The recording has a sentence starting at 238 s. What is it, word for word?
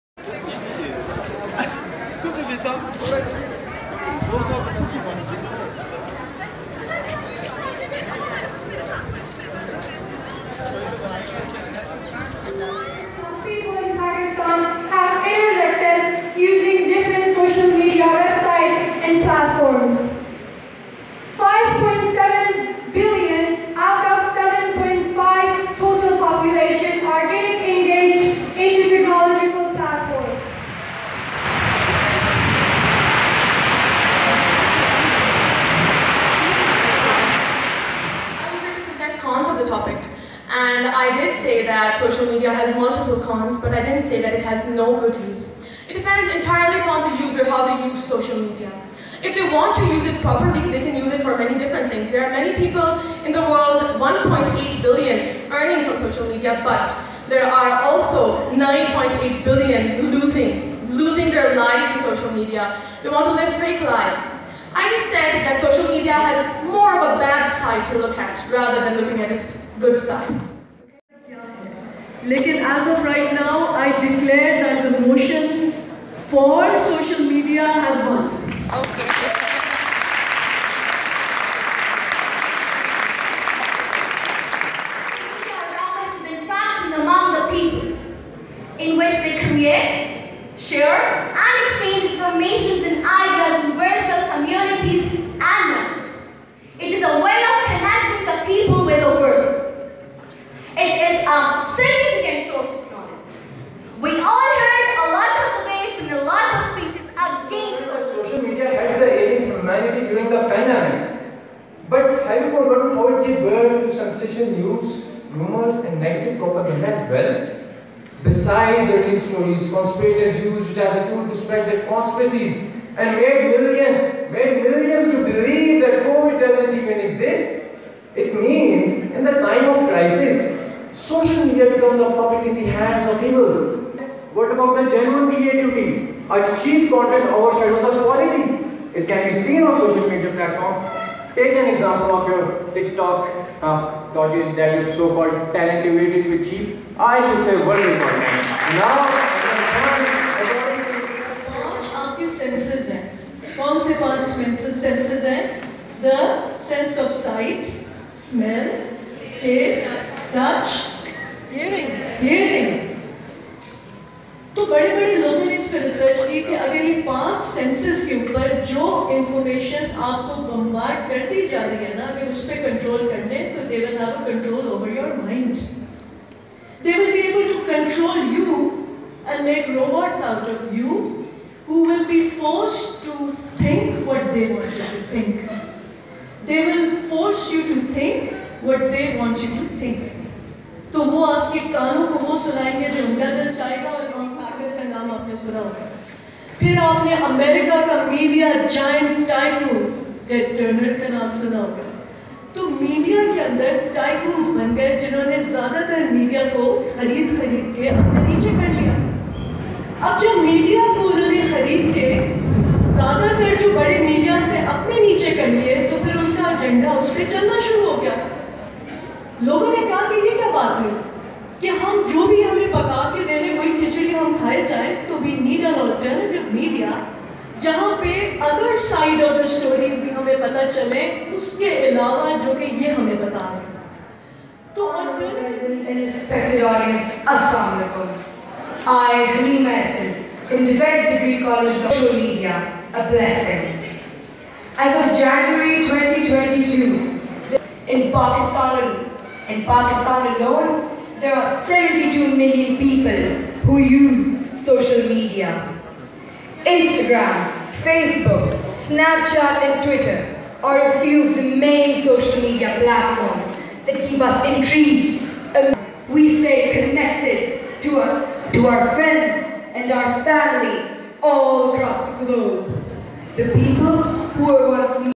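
I, Halim Mason, from Defense Degree College of Social Media, a blessing.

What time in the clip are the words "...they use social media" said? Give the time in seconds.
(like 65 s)
47 s.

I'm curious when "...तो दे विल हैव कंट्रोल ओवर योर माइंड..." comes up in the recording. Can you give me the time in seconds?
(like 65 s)
173 s.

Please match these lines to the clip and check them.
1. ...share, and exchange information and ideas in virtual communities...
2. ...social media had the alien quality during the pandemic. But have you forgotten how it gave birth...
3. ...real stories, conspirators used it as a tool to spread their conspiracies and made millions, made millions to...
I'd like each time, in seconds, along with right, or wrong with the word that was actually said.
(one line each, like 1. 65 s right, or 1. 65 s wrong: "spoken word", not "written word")
1. 90 s right
2. 108 s wrong: "humanity", not "quality"
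3. 119 s right.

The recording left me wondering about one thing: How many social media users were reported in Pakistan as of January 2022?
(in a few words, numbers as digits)
72 million.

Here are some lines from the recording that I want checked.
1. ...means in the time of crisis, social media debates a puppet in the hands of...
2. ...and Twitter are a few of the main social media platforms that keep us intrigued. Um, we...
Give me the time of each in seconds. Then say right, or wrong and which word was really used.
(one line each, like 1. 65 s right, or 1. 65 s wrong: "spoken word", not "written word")
1. 128 s wrong: "becomes", not "debates"
2. 259 s right.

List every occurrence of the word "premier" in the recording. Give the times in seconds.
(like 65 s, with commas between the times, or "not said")
not said.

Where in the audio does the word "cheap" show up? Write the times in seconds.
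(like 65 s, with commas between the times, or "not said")
136 s, 146 s.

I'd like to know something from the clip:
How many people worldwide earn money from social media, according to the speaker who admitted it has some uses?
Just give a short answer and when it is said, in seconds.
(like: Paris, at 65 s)
1.8 billion, at 53 s.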